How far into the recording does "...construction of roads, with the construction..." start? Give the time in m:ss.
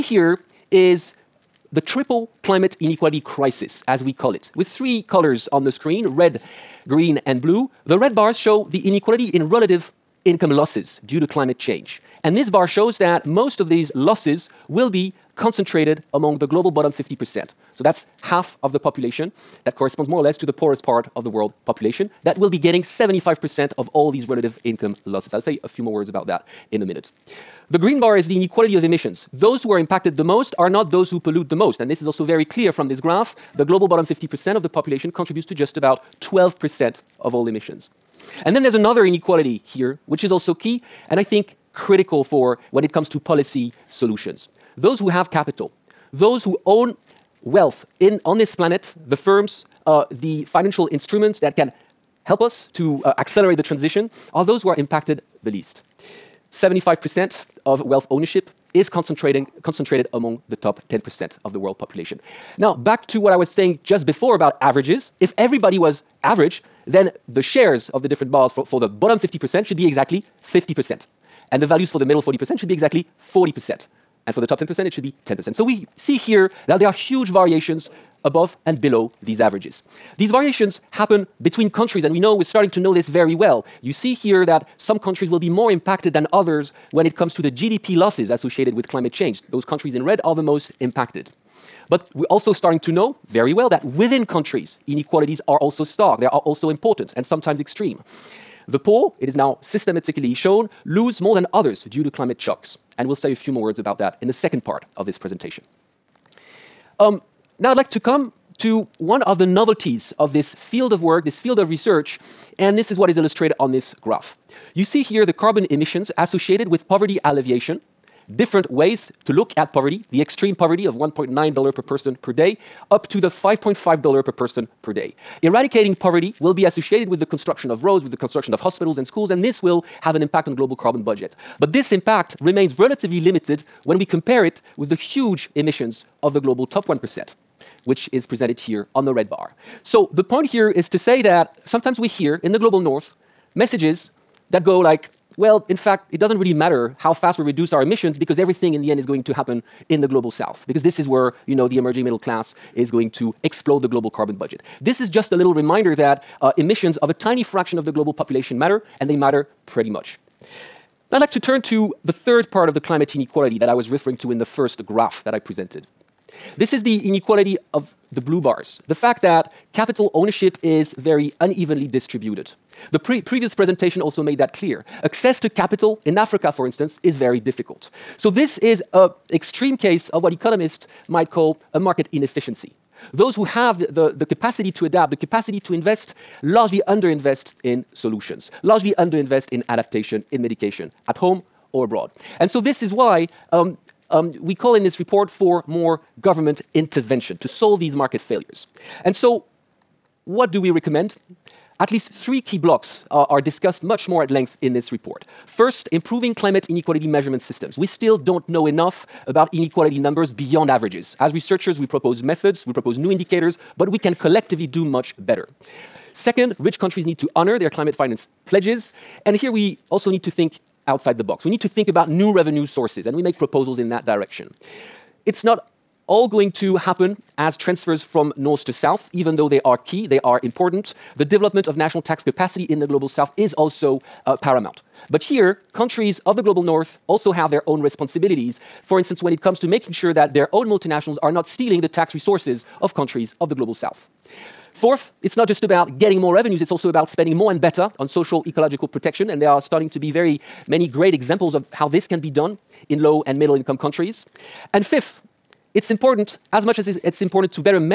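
2:07.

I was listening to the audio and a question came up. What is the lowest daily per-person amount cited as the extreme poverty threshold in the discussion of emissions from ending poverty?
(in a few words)
$1.9.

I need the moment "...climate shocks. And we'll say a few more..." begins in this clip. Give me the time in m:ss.
1:42.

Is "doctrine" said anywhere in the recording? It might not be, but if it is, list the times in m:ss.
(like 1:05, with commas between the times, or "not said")
not said.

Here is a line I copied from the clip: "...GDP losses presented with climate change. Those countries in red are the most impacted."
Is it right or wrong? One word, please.
wrong.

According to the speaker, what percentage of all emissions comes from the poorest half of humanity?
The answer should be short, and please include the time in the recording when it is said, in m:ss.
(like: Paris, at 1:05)
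12%, at 0:36.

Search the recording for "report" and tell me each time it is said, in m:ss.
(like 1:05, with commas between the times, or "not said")
3:14, 3:24.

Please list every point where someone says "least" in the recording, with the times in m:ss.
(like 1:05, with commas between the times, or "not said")
0:55, 3:21.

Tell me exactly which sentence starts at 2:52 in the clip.
The pre previous presentation also made that clear.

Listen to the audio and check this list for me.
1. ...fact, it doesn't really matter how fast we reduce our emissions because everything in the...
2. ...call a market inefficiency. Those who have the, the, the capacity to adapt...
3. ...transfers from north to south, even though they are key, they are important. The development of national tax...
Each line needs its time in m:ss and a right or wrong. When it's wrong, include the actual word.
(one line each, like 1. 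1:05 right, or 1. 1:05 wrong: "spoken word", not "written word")
1. 2:25 right
2. 3:01 right
3. 3:47 right.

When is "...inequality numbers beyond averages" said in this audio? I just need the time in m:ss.
3:29.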